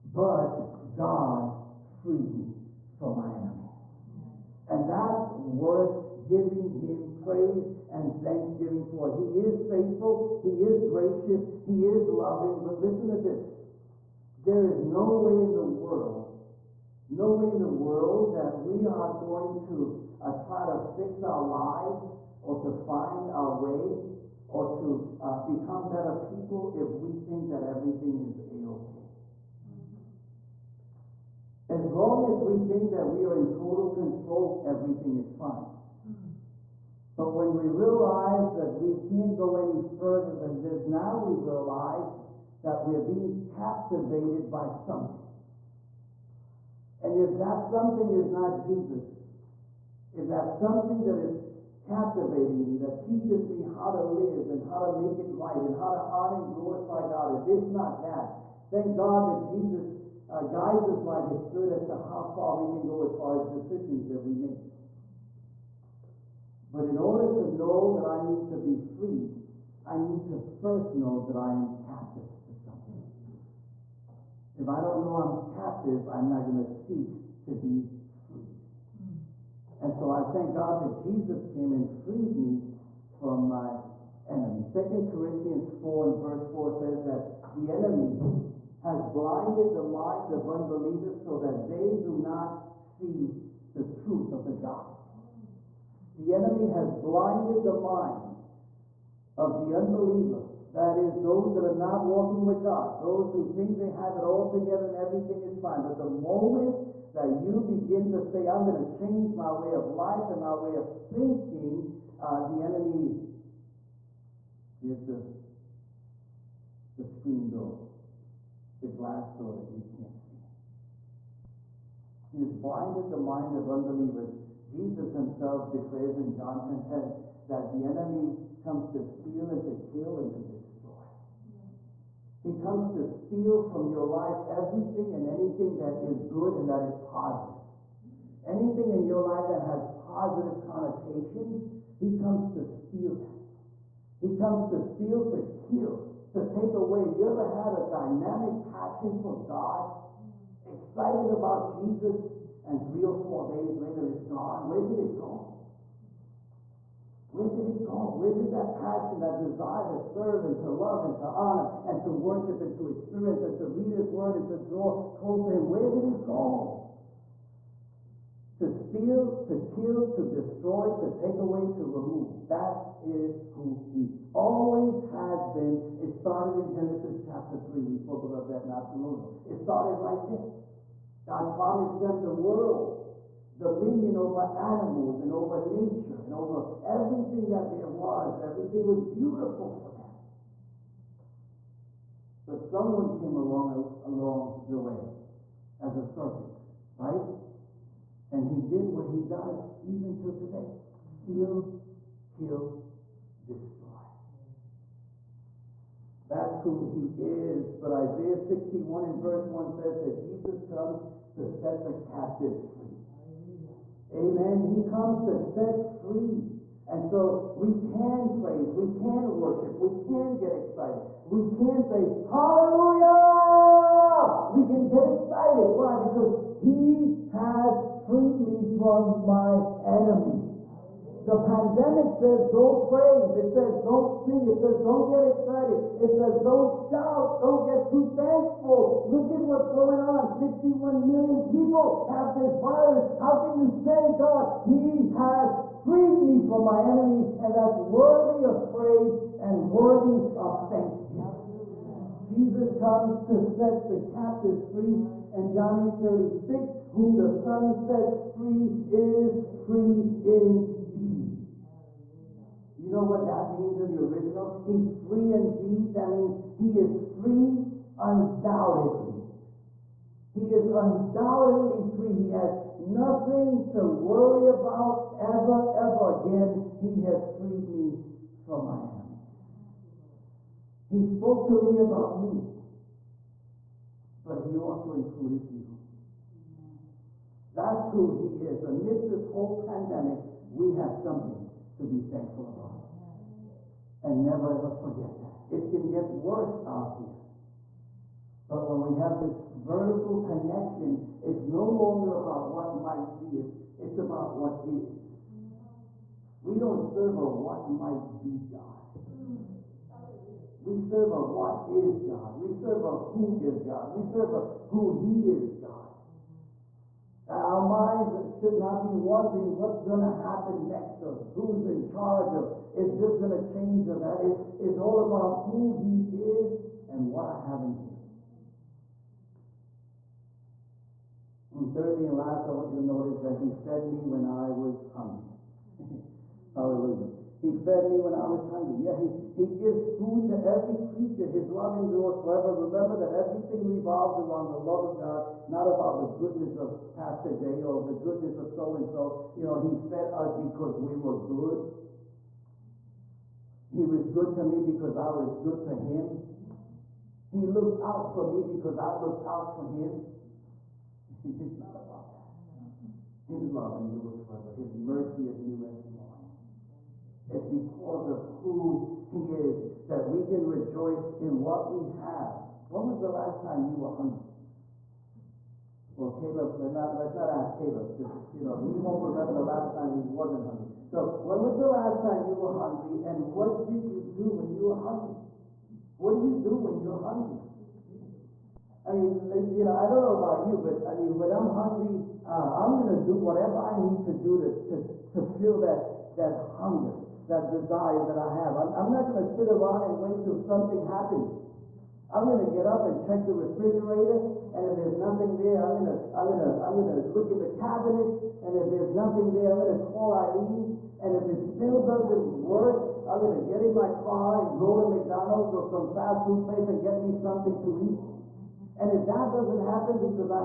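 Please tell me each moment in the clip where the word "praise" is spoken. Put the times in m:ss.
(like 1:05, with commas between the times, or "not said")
0:07, 3:38, 3:52, 4:08.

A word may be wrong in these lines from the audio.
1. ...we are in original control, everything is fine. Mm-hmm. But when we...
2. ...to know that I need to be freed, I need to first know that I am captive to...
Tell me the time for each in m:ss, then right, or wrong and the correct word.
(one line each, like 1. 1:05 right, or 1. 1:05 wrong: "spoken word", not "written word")
1. 0:33 wrong: "total", not "original"
2. 1:07 right.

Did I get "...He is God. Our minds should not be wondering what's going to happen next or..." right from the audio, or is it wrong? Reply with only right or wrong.
right.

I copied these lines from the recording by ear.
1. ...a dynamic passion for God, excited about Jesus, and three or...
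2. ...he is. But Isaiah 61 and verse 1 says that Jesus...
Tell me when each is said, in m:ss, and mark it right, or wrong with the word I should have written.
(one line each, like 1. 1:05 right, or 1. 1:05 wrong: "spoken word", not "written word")
1. 2:27 right
2. 3:26 right.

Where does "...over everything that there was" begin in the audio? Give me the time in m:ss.
3:06.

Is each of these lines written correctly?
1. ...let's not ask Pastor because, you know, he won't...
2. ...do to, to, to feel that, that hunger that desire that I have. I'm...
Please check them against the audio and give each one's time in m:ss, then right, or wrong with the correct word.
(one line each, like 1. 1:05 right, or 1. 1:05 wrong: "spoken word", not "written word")
1. 6:16 wrong: "Caleb", not "Pastor"
2. 6:34 right.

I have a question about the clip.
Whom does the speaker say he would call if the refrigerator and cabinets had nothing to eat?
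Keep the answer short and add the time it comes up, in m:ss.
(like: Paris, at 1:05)
Eileen, at 6:50.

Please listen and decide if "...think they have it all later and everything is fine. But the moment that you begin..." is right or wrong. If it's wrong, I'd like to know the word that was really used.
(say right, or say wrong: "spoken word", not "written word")
wrong: "together", not "later".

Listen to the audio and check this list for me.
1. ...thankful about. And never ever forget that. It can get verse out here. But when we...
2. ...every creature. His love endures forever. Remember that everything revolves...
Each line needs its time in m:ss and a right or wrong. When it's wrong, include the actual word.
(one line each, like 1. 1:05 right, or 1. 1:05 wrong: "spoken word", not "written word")
1. 4:52 wrong: "worse", not "verse"
2. 5:40 right.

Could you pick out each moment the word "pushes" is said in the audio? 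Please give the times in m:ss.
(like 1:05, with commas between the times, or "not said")
not said.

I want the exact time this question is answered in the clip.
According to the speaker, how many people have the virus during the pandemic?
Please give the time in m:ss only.
4:00.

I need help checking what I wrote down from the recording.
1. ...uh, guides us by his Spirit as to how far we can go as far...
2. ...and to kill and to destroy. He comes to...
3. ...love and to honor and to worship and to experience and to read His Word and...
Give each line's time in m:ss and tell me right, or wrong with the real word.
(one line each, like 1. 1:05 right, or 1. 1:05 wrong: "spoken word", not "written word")
1. 1:00 right
2. 2:09 right
3. 2:40 right.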